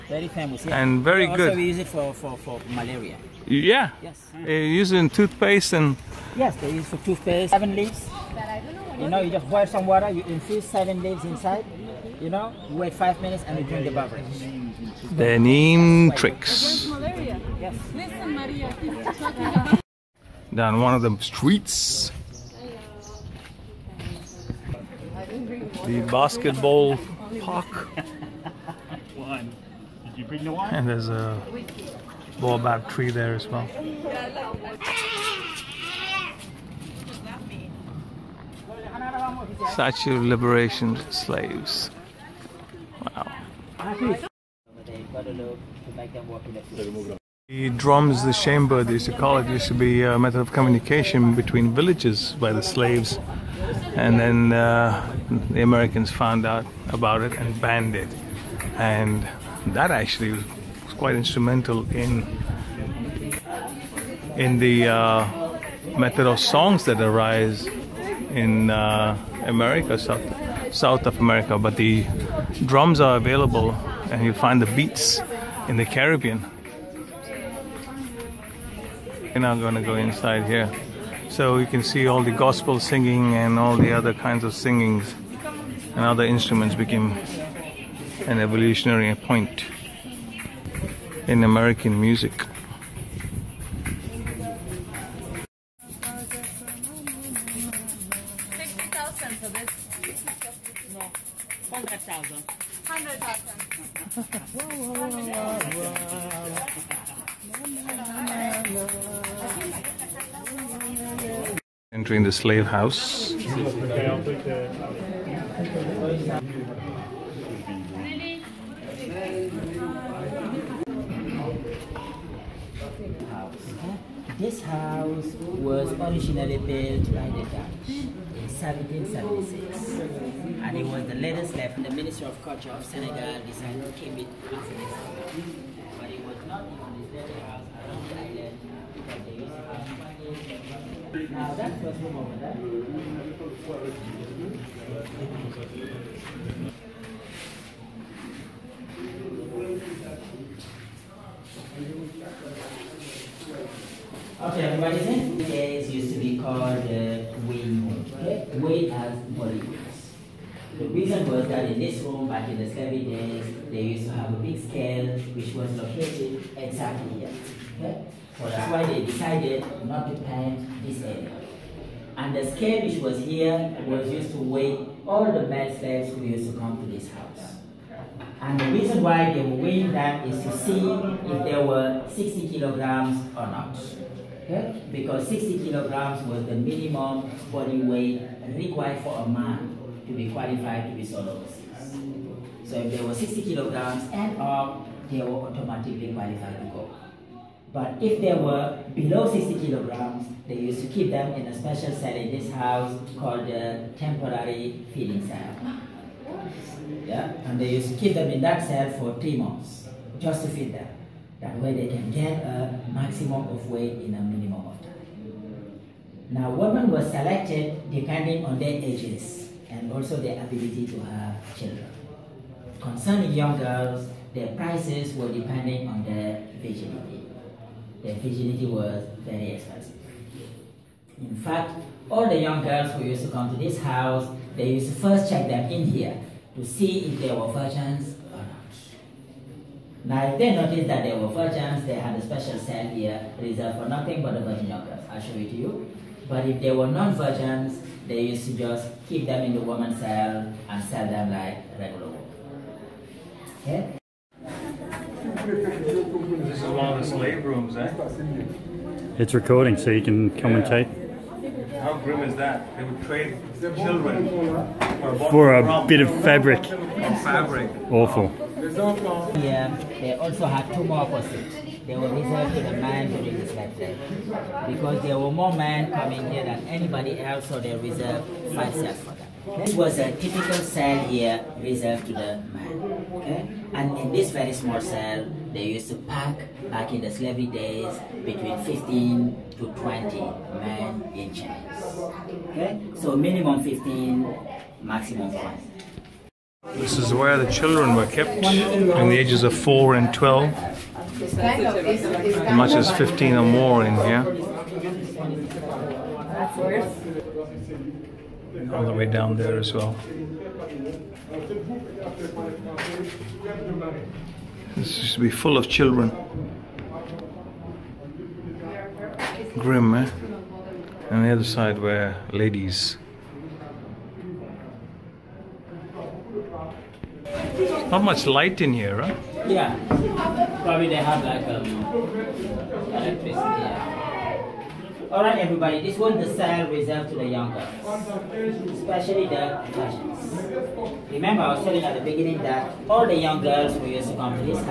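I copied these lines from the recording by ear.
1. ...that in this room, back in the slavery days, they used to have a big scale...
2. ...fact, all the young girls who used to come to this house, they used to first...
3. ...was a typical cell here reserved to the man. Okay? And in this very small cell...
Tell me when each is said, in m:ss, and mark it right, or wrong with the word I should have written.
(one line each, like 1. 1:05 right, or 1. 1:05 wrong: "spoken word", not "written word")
1. 2:41 right
2. 3:51 right
3. 4:39 right.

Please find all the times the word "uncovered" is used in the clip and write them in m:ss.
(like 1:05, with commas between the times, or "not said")
not said.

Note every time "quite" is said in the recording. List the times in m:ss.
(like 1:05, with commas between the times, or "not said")
1:00.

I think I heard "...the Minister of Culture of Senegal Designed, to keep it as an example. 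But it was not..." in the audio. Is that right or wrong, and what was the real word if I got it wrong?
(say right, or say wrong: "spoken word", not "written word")
right.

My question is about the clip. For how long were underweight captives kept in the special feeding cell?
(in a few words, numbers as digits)
3 months.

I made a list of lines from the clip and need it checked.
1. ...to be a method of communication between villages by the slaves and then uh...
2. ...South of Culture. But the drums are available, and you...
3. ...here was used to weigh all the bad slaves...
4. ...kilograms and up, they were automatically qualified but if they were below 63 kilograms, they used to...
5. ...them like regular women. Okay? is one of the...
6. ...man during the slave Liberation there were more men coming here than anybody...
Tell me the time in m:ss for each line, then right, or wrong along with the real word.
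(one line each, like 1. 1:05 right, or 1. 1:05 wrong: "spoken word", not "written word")
1. 0:49 right
2. 1:10 wrong: "America", not "Culture"
3. 2:53 right
4. 3:13 wrong: "60", not "63"
5. 4:11 right
6. 4:32 wrong: "Because", not "Liberation".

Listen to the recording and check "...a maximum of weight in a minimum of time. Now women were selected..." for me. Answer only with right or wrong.
right.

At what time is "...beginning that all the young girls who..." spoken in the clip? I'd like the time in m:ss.
5:42.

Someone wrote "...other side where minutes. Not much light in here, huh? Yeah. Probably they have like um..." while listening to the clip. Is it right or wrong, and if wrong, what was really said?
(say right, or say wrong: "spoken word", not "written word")
wrong: "ladies", not "minutes".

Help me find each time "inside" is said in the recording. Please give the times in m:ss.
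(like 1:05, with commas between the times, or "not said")
0:11, 1:19.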